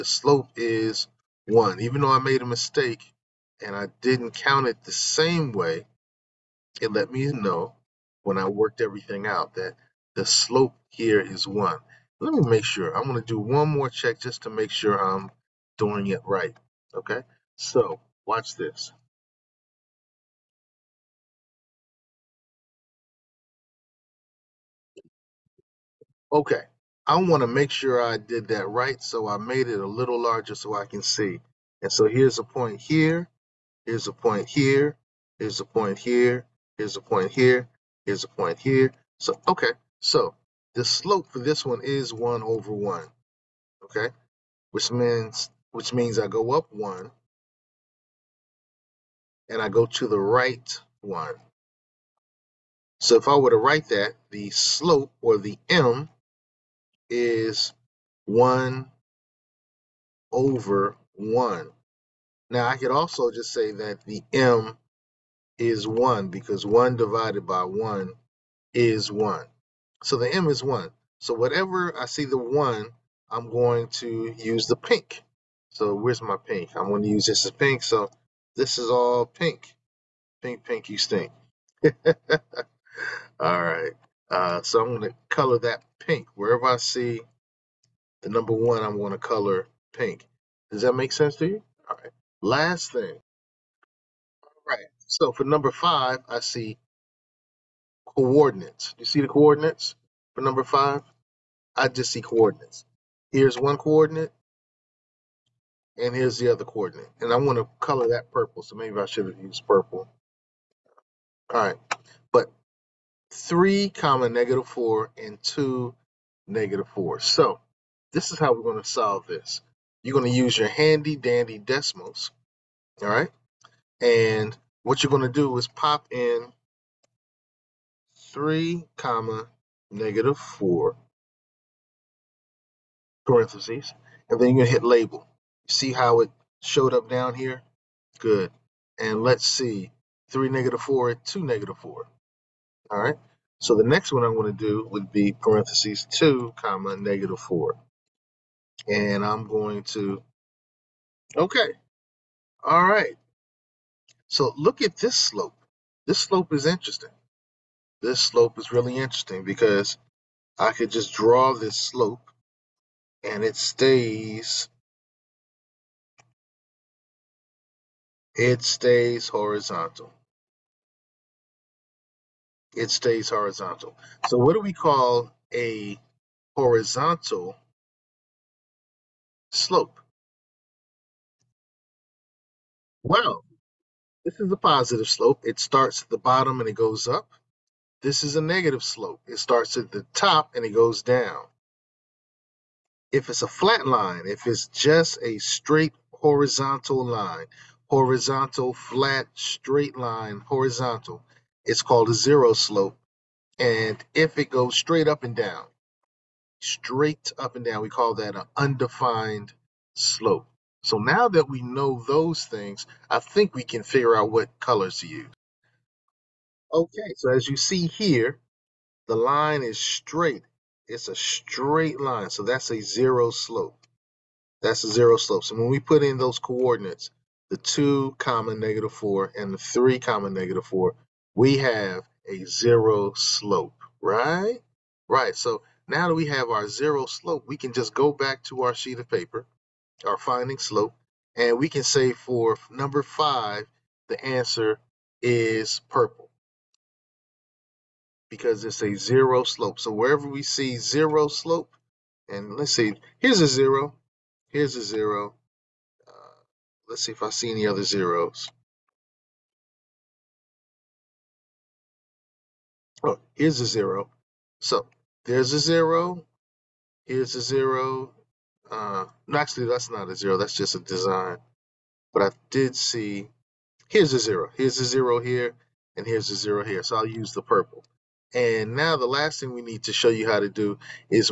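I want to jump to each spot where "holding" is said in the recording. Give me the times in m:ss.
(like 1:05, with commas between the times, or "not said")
not said.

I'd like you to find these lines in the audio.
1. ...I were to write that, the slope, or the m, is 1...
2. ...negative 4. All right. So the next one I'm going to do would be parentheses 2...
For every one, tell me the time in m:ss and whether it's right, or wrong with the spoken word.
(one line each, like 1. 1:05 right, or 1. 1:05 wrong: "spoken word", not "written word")
1. 0:53 right
2. 2:21 right.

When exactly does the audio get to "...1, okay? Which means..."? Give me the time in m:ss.
0:42.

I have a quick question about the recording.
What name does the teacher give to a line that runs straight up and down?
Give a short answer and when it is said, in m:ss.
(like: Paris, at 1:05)
Undefined slope, at 3:28.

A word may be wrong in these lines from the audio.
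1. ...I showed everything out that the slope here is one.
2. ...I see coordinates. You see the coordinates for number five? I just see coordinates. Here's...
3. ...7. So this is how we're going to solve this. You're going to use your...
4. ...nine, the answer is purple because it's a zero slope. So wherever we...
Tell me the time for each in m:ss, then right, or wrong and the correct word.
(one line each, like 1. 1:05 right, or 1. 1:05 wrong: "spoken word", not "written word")
1. 0:08 wrong: "worked", not "showed"
2. 1:36 right
3. 1:56 wrong: "4", not "7"
4. 4:03 wrong: "five", not "nine".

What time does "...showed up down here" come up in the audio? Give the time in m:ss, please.
2:16.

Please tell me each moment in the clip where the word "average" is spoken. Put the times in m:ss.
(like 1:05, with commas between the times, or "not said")
not said.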